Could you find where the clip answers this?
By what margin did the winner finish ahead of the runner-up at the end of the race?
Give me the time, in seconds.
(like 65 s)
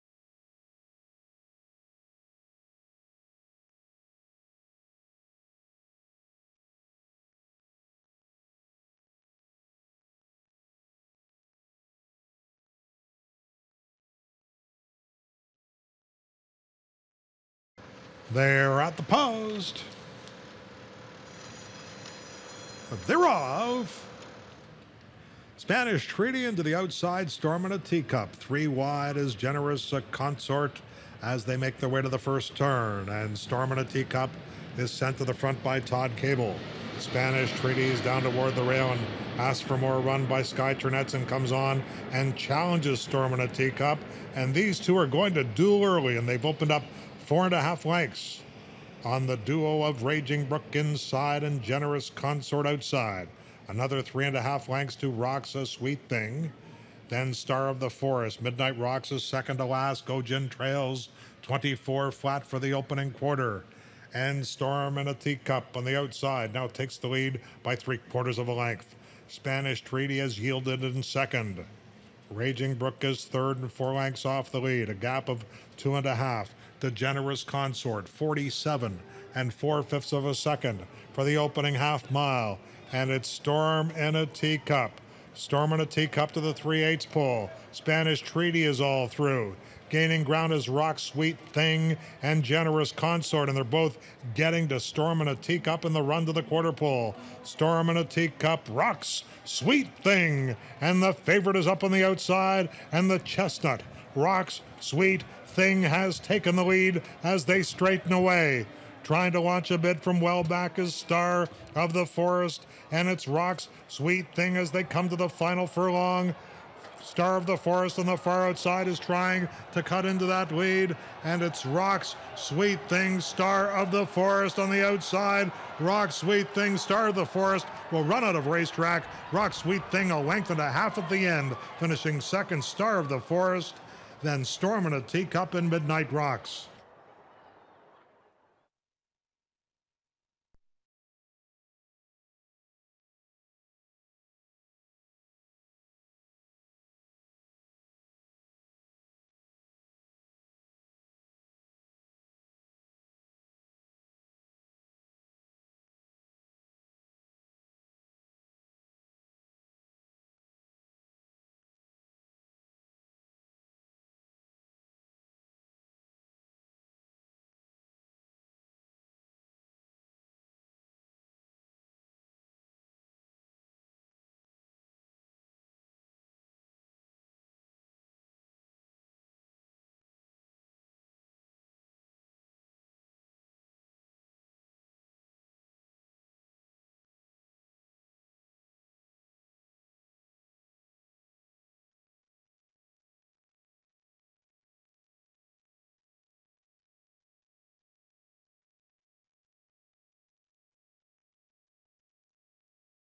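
130 s.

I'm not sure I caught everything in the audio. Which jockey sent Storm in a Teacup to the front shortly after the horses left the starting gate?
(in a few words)
Todd Kabel.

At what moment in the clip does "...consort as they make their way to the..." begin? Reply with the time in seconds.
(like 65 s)
30 s.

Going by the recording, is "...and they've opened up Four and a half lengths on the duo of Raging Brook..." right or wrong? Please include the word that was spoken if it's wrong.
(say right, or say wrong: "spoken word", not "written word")
right.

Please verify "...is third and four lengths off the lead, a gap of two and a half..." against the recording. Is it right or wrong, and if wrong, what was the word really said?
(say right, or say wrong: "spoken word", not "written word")
right.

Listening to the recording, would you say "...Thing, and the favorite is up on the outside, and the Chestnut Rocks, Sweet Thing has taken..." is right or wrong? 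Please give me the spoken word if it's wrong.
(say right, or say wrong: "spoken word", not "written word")
right.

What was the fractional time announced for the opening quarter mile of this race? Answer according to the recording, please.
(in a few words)
24 flat.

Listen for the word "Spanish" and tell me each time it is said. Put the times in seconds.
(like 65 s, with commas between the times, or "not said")
25 s, 36 s, 69 s, 87 s.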